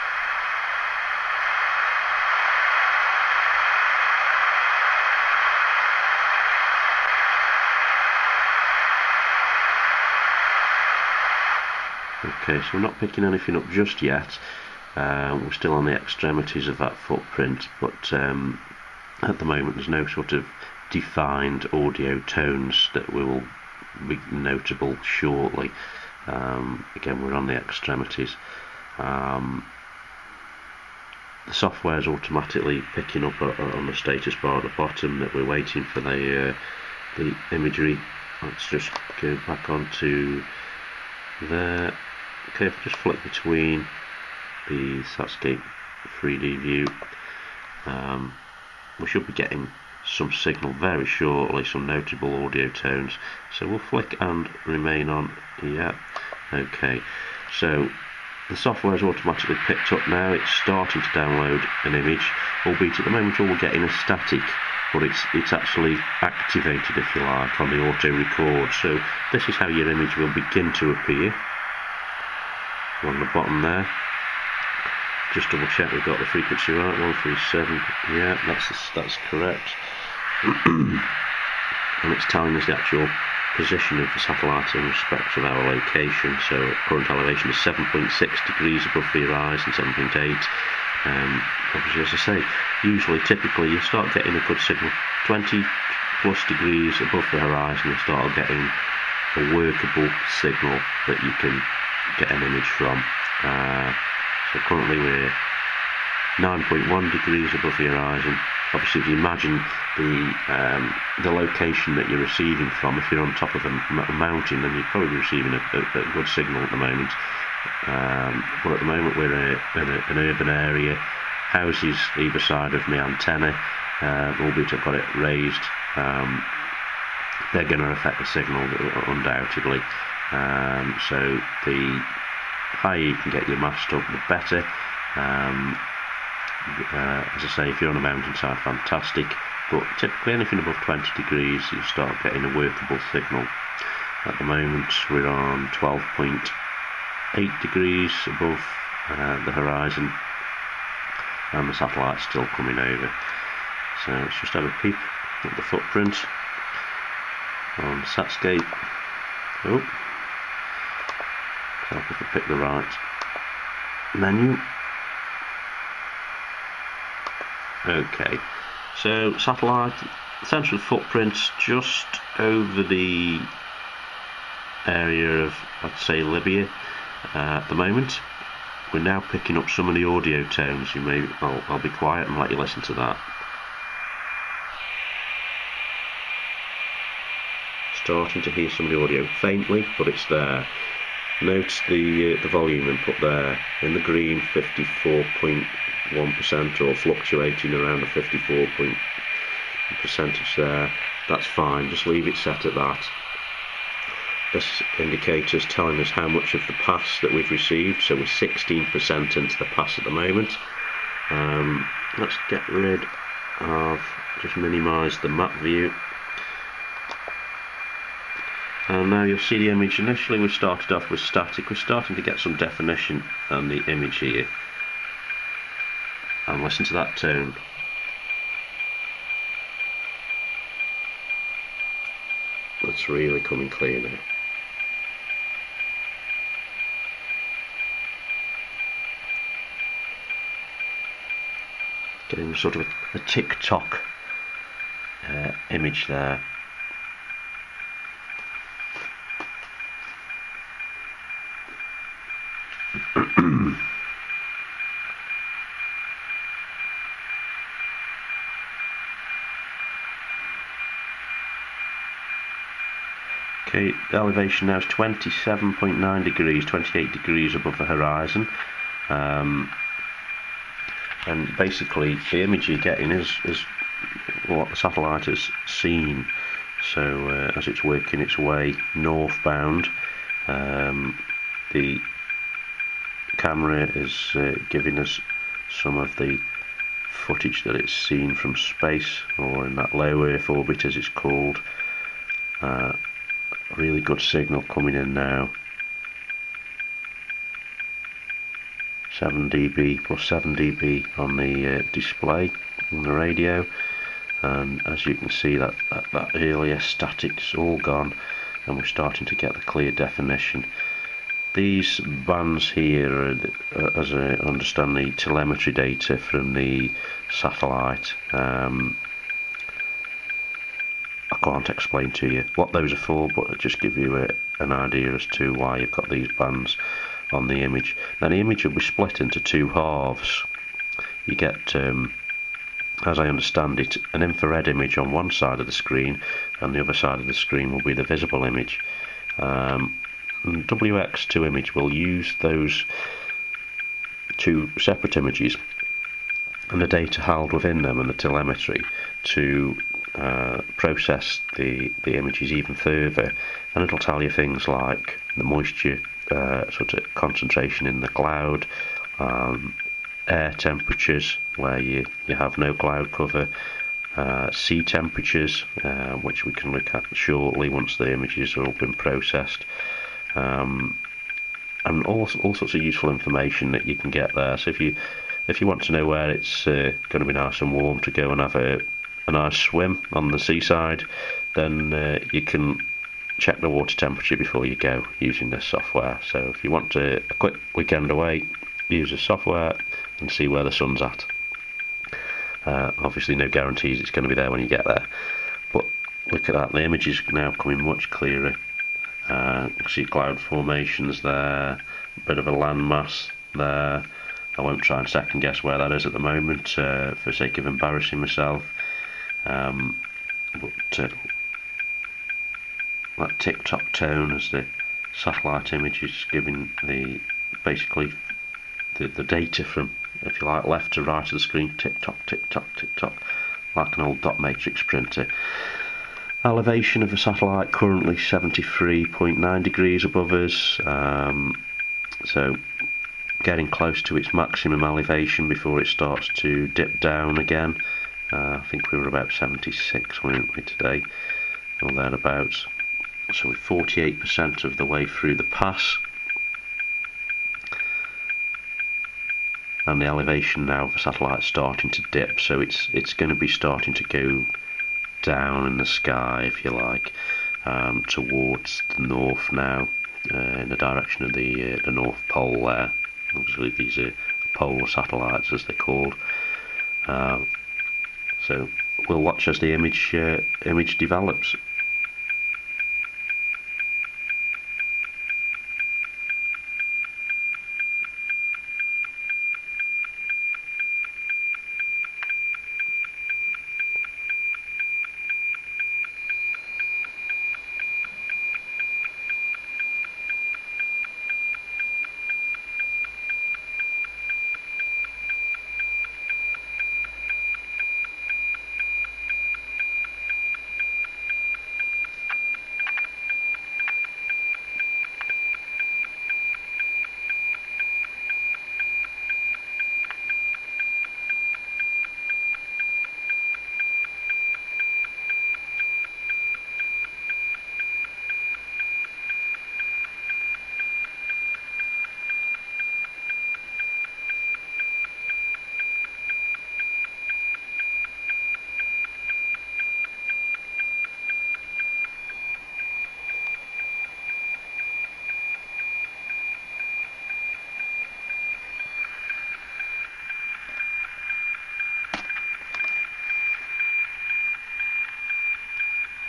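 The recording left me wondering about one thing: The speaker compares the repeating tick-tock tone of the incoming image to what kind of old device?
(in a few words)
dot matrix printer.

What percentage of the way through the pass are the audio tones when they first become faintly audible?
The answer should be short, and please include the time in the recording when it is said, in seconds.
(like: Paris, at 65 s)
16%, at 208 s.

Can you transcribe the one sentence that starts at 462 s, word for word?
There, obviously these are polar satellites as they're called.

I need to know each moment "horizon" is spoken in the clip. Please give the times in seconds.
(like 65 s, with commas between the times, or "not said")
89 s, 97 s, 107 s, 149 s, 267 s.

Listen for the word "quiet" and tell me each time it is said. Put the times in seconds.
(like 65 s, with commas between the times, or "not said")
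181 s.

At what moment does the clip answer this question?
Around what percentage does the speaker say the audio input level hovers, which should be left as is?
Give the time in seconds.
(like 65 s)
194 s.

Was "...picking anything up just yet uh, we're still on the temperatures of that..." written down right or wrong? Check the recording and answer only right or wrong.
wrong.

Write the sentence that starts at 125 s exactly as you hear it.
Um, they're going to affect the signal uh, undoubtedly.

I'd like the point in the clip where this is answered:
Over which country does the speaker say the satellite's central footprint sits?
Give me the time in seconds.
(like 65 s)
176 s.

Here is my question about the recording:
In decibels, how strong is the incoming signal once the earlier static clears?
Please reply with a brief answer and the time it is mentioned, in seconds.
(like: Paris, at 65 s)
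+7 dB, at 300 s.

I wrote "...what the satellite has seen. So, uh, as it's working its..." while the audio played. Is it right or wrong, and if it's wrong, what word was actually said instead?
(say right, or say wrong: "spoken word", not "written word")
right.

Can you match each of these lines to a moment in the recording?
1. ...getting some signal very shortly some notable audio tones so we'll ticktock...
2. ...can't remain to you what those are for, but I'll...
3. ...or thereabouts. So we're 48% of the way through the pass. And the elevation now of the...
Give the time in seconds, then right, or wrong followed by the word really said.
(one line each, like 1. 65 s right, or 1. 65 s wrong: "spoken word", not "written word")
1. 49 s wrong: "flick", not "ticktock"
2. 321 s wrong: "explain", not "remain"
3. 441 s right.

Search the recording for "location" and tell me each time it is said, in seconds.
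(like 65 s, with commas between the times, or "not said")
85 s, 111 s.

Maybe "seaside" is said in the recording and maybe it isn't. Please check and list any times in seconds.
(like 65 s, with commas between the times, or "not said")
380 s.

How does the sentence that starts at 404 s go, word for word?
I won't try and second guess where that is at the moment uh, for sake of embarrassing myself.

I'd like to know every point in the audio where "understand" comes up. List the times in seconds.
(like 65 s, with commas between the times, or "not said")
314 s, 333 s.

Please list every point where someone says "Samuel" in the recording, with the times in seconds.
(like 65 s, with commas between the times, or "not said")
not said.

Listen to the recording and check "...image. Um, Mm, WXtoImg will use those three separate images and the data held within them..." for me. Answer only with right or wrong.
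wrong.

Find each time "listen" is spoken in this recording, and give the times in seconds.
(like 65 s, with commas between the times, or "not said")
182 s, 226 s.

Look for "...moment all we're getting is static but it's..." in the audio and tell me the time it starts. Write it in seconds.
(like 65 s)
63 s.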